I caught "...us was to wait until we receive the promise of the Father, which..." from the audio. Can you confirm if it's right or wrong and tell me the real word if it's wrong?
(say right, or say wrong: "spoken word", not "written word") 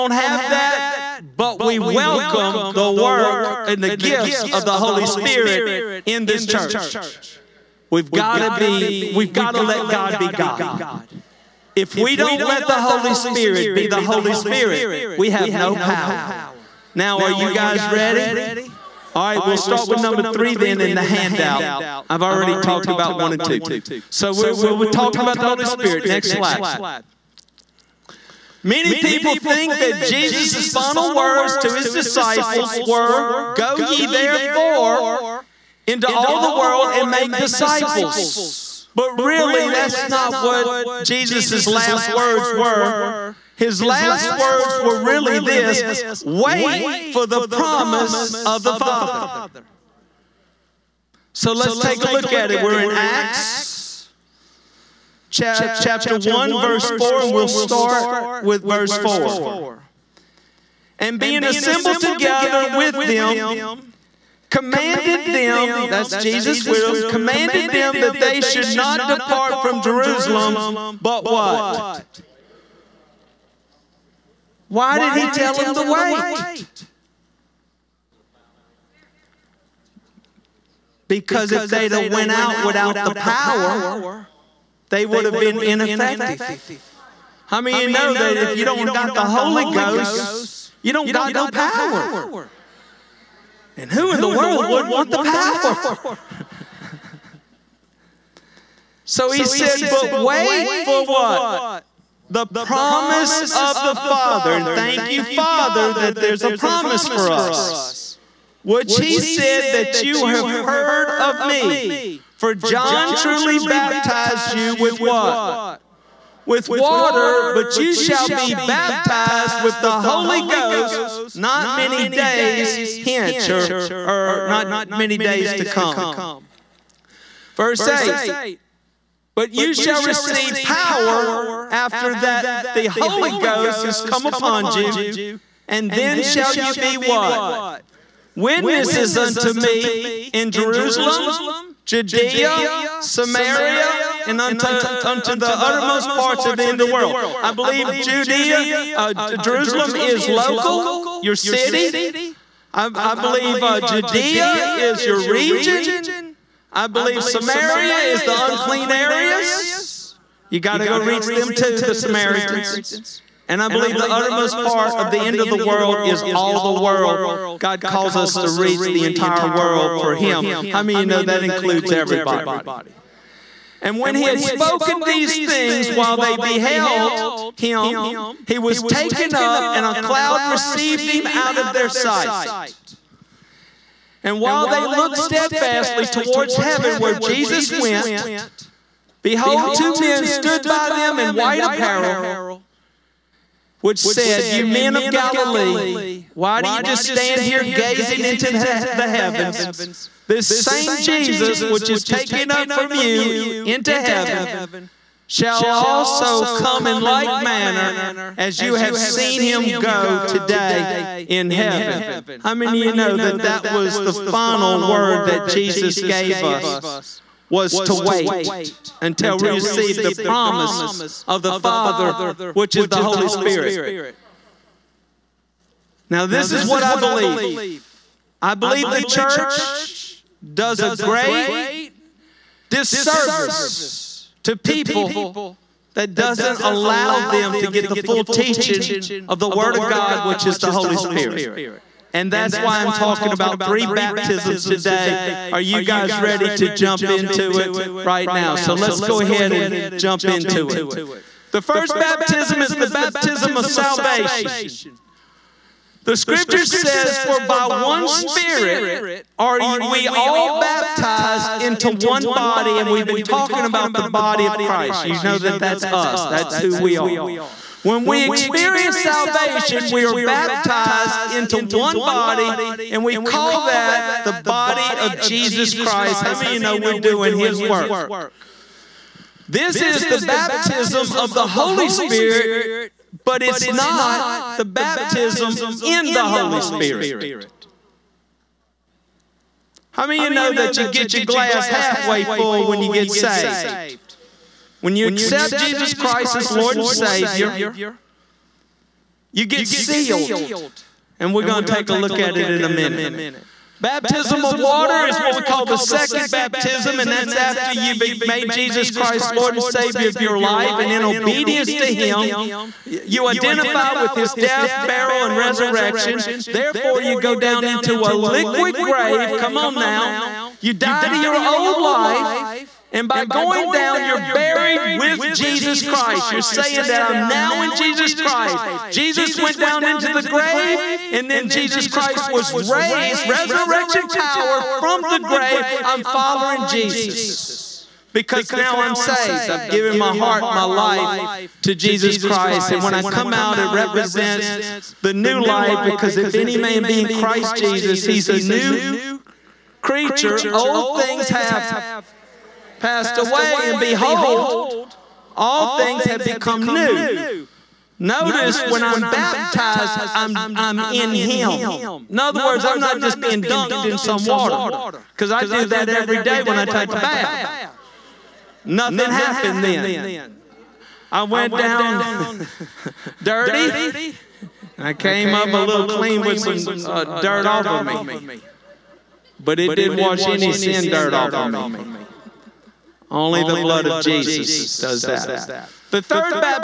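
right.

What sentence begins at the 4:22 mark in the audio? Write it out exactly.
And we've been talking about the body of Christ.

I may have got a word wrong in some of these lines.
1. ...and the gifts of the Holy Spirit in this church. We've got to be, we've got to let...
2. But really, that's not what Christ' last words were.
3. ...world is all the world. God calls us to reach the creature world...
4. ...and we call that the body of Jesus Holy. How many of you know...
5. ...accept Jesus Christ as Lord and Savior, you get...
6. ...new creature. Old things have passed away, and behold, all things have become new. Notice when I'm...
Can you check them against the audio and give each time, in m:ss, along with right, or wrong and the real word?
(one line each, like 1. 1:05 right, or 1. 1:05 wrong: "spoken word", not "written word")
1. 0:03 right
2. 0:38 wrong: "Jesus", not "Christ"
3. 2:45 wrong: "entire", not "creature"
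4. 4:32 wrong: "Christ", not "Holy"
5. 4:55 right
6. 5:48 right.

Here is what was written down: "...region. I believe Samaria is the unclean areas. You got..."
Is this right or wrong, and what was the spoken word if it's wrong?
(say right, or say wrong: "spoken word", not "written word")
right.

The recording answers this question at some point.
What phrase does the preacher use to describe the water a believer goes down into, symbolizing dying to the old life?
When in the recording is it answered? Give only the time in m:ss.
5:18.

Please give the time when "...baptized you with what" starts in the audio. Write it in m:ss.
1:53.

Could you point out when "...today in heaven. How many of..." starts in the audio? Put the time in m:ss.
3:30.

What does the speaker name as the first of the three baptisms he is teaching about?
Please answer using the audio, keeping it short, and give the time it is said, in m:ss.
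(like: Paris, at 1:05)
Baptism of salvation, at 4:12.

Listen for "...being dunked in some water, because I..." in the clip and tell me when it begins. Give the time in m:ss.
6:03.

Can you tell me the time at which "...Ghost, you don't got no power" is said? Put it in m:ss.
1:29.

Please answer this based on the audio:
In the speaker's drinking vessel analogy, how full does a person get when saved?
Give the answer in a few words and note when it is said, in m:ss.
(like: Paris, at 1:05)
Halfway full, at 4:51.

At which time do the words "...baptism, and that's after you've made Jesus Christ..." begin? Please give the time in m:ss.
5:06.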